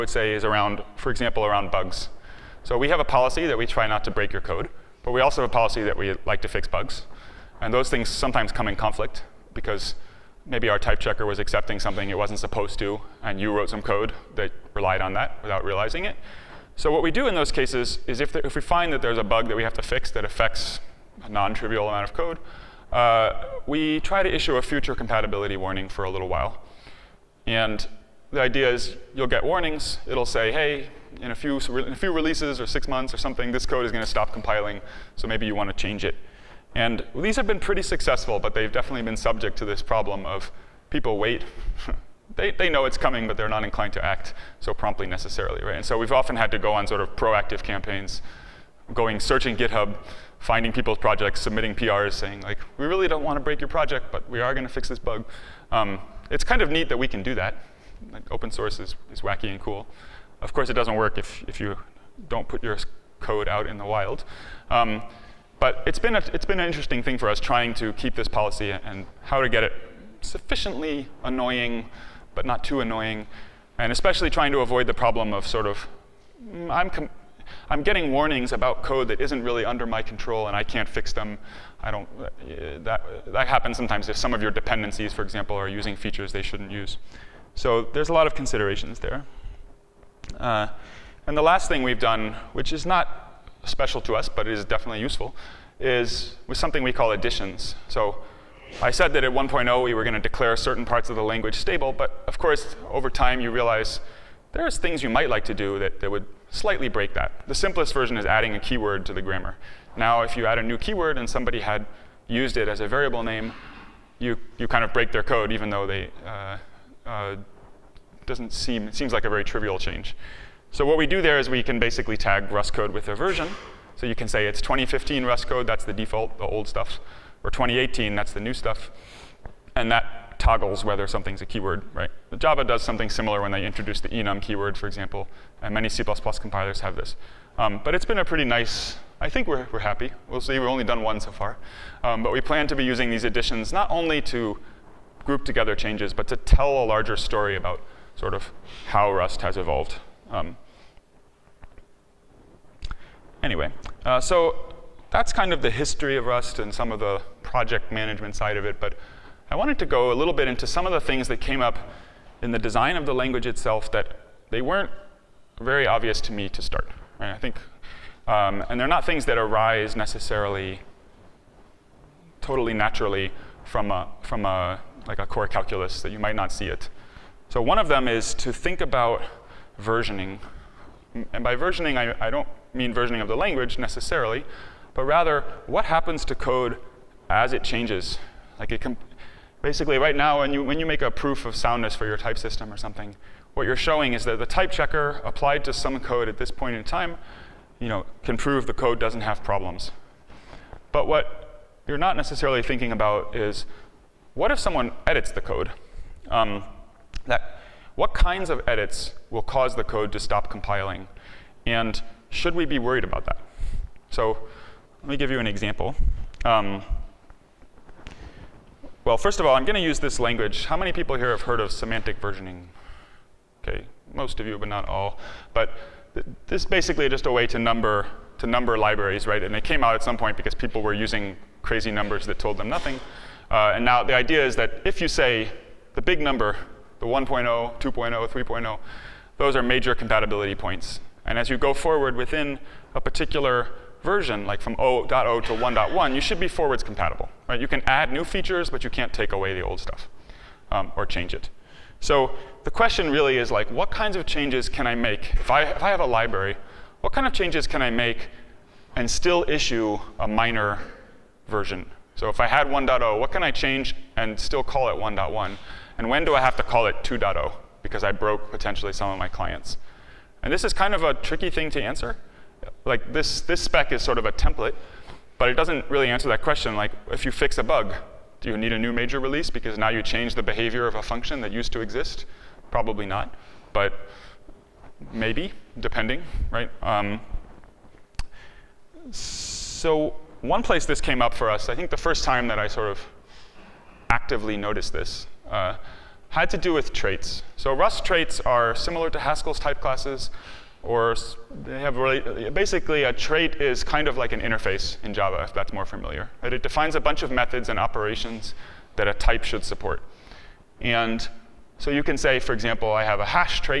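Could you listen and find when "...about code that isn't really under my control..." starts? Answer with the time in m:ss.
1:18.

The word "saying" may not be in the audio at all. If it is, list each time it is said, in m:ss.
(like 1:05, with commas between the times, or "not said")
0:52.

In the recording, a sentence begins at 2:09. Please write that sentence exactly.
And that toggles whether something's a keyword, right?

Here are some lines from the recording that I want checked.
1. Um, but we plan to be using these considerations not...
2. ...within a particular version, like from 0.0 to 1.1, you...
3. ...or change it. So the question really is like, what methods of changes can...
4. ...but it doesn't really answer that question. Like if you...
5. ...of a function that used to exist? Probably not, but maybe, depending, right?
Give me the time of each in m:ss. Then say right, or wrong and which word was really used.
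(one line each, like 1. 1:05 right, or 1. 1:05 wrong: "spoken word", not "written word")
1. 2:22 wrong: "editions", not "considerations"
2. 4:02 right
3. 4:10 wrong: "kinds", not "methods"
4. 4:35 right
5. 4:40 right.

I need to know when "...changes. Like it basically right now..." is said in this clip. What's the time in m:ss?
3:07.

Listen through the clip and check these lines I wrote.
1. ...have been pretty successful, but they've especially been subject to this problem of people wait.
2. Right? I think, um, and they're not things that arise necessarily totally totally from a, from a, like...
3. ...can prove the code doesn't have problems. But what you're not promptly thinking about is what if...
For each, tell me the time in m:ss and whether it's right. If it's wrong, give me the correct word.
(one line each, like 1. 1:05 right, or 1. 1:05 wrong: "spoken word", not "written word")
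1. 0:37 wrong: "definitely", not "especially"
2. 2:47 wrong: "naturally", not "totally"
3. 3:18 wrong: "necessarily", not "promptly".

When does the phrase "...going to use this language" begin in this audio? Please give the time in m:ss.
3:39.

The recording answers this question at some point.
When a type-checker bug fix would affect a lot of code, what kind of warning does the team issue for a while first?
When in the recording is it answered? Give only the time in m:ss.
0:24.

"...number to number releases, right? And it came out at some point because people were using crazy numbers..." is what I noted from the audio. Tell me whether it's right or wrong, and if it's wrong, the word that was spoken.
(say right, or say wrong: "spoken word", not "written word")
wrong: "libraries", not "releases".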